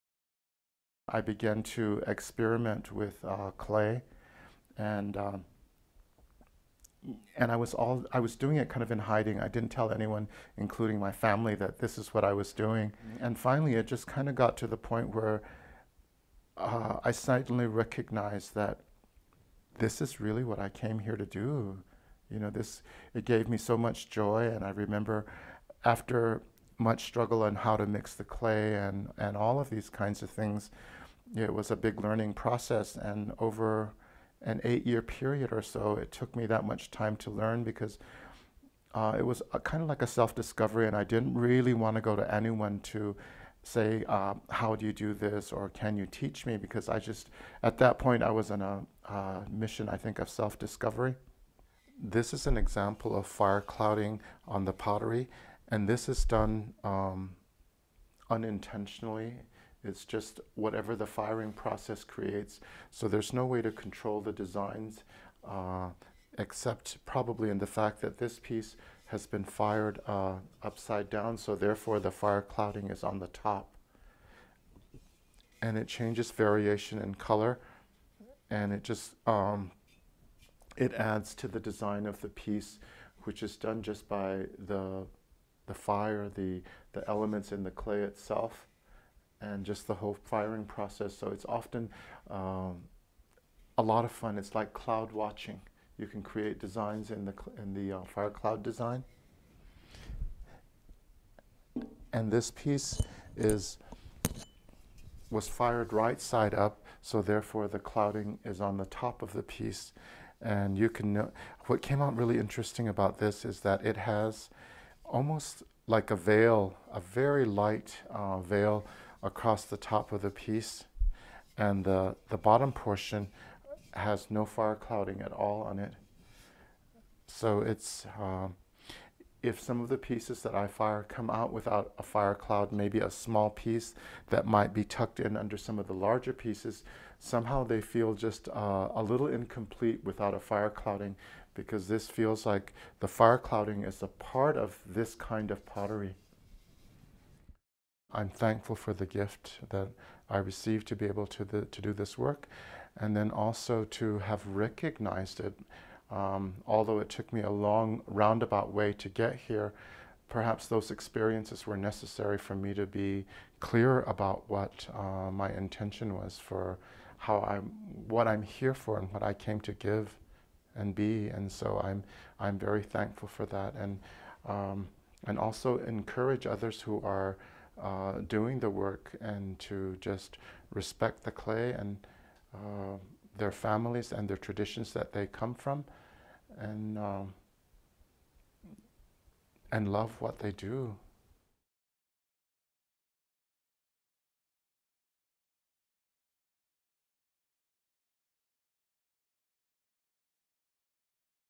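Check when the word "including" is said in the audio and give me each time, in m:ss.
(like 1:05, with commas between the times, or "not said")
0:10.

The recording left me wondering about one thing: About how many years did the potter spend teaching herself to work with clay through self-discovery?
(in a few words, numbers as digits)
8.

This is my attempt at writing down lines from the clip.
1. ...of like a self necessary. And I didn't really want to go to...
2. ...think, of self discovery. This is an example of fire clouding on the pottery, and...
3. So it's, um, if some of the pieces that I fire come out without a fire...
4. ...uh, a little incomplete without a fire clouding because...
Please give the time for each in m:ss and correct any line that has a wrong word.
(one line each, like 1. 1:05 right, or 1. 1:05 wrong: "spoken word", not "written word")
1. 0:39 wrong: "discovery", not "necessary"
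2. 0:49 right
3. 2:07 right
4. 2:18 right.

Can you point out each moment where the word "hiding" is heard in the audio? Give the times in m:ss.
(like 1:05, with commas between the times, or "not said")
0:08.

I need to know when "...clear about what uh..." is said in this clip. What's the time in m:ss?
2:43.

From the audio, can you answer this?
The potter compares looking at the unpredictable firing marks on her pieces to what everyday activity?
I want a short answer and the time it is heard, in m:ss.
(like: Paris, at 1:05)
cloud watching, at 1:34.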